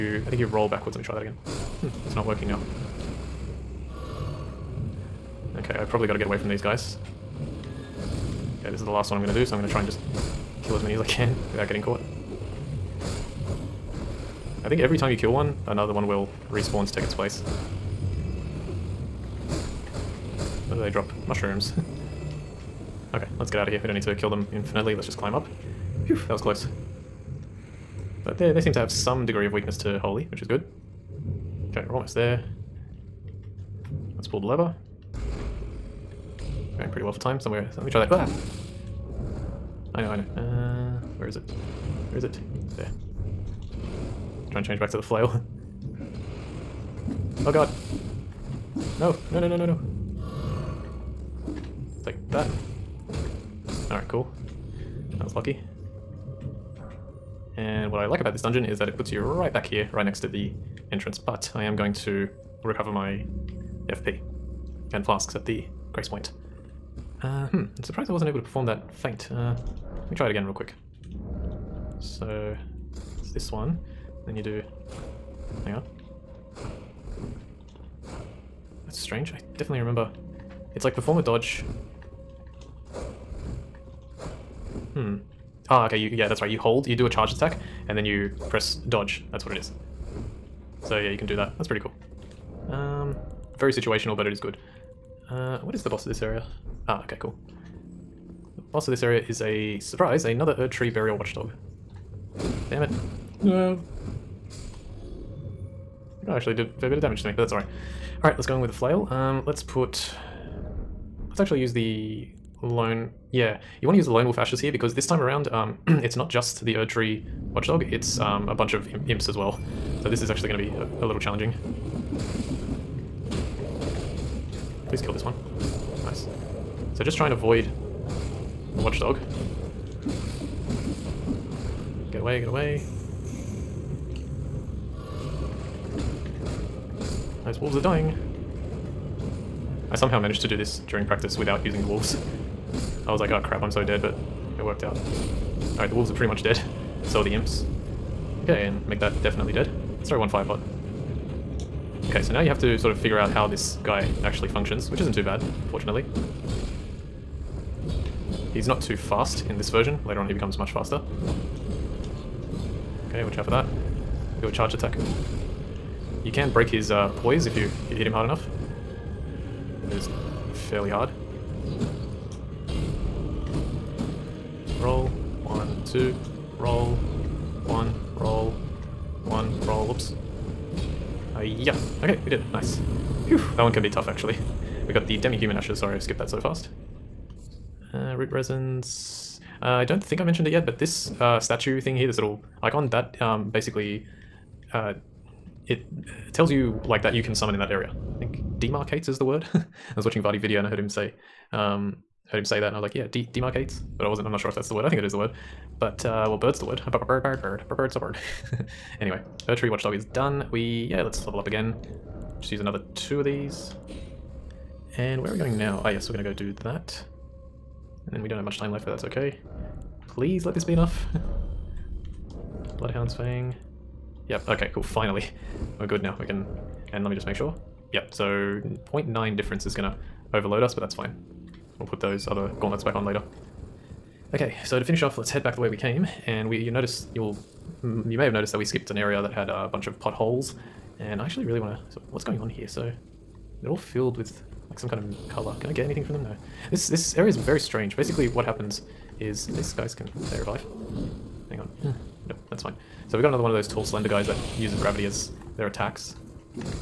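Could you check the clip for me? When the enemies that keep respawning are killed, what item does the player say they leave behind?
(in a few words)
Mushrooms.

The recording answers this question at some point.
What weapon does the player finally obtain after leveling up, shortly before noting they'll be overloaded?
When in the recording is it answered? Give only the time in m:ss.
3:42.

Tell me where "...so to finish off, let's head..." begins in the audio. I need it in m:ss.
3:54.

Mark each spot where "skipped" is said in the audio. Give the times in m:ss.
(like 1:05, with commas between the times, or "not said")
3:05, 3:58.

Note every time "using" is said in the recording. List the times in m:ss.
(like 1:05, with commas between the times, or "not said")
2:21.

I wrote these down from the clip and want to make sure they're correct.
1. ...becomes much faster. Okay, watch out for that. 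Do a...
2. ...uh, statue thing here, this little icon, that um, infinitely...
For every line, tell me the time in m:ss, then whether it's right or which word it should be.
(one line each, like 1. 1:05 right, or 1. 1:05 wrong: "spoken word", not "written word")
1. 2:40 right
2. 3:11 wrong: "basically", not "infinitely".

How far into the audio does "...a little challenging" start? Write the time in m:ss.
2:01.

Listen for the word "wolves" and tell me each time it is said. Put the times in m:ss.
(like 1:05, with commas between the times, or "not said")
2:17, 2:21, 2:25.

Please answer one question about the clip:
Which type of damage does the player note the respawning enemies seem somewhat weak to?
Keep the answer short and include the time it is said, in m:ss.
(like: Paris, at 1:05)
Holy, at 0:29.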